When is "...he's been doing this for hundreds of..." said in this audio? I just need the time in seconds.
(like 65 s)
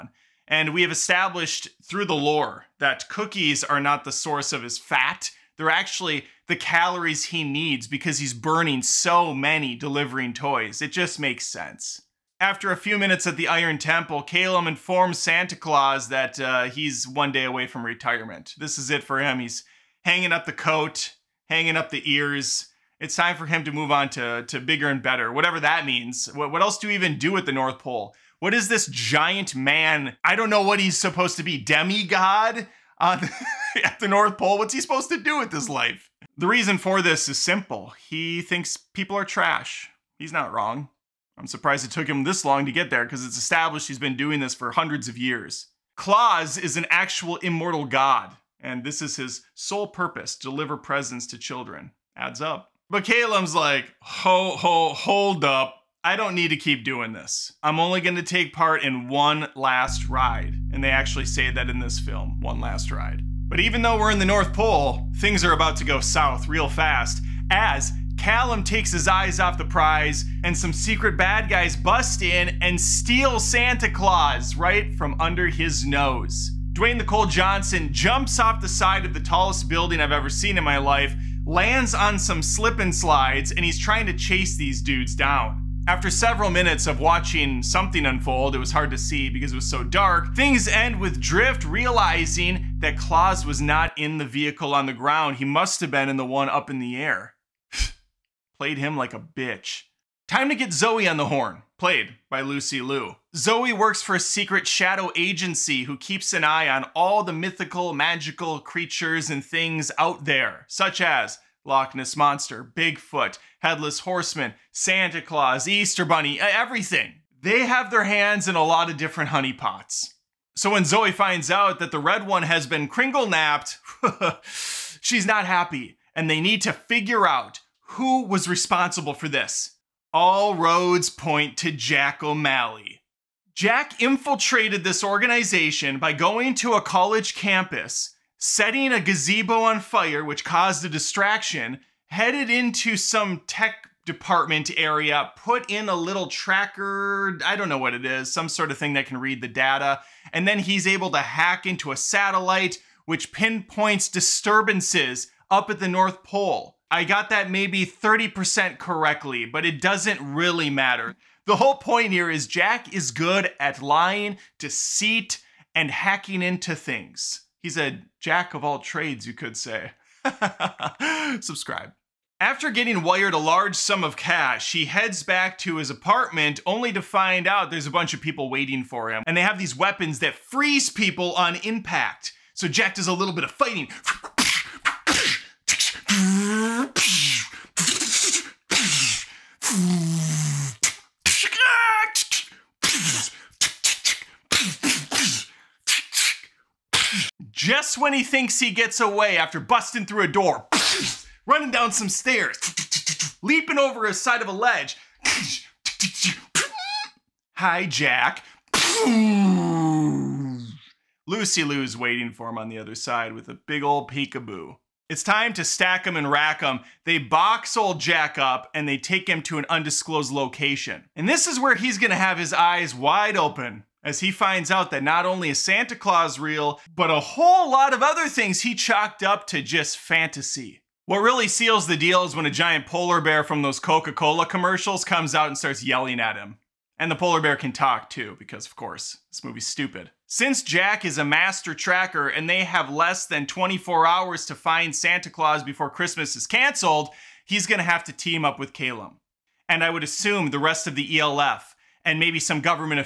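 43 s.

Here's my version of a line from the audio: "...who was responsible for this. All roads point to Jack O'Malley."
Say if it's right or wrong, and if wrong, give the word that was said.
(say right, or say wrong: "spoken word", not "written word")
right.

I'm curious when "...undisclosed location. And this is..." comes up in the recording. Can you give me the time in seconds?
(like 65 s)
219 s.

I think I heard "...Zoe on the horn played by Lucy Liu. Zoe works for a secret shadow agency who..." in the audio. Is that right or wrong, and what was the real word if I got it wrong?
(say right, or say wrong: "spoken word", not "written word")
right.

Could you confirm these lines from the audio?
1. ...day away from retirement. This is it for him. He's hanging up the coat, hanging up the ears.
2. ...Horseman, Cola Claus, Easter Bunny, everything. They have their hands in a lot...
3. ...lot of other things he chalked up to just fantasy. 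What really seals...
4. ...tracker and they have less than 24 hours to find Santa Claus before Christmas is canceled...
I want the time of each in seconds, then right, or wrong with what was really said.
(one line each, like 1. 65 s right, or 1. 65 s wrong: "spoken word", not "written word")
1. 17 s right
2. 114 s wrong: "Santa", not "Cola"
3. 227 s right
4. 241 s right.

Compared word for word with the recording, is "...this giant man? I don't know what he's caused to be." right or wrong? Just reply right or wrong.
wrong.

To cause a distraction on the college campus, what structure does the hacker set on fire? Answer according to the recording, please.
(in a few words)
A gazebo.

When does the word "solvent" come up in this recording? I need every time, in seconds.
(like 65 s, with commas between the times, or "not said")
not said.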